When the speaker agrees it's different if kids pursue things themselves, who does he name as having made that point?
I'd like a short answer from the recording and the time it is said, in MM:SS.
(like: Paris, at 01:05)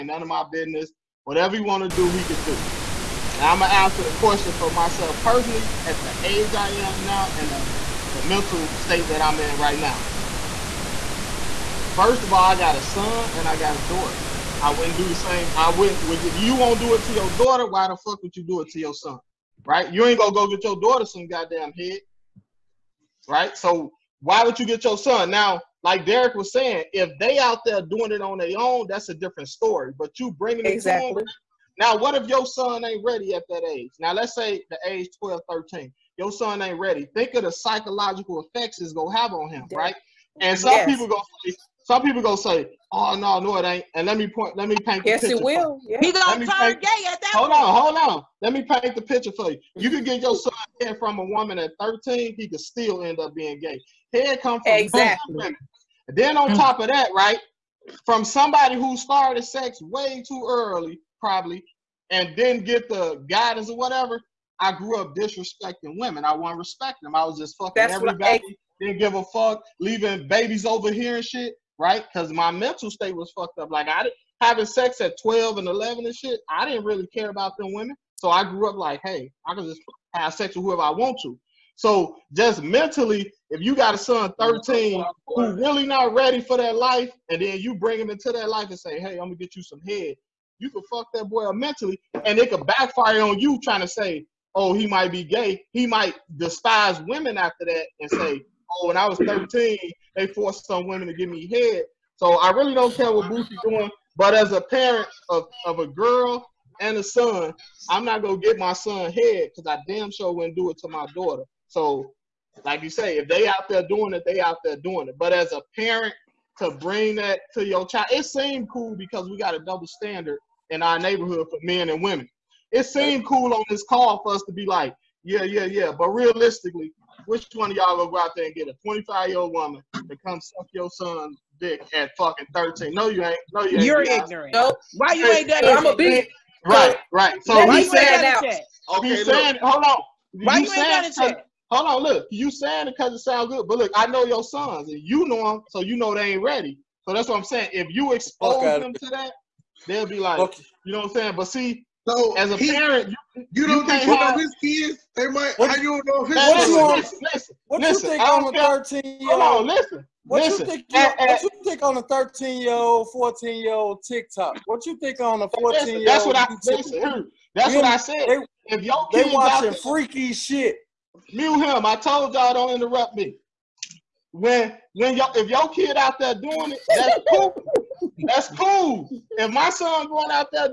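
Derek, at 00:26.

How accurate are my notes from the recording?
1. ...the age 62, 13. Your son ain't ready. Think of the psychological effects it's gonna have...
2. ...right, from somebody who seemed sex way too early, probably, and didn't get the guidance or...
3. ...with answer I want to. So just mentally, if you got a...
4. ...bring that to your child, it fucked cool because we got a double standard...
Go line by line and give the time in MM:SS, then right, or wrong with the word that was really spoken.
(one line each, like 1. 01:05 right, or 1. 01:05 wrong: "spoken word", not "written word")
1. 00:34 wrong: "12", not "62"
2. 00:57 wrong: "started", not "seemed"
3. 01:20 wrong: "whoever", not "answer"
4. 01:56 wrong: "seemed", not "fucked".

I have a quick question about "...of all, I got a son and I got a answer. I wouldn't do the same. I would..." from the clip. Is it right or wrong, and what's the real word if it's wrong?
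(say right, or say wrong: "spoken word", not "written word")
wrong: "daughter", not "answer".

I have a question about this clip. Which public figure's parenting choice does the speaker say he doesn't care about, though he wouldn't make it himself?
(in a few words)
Boosie.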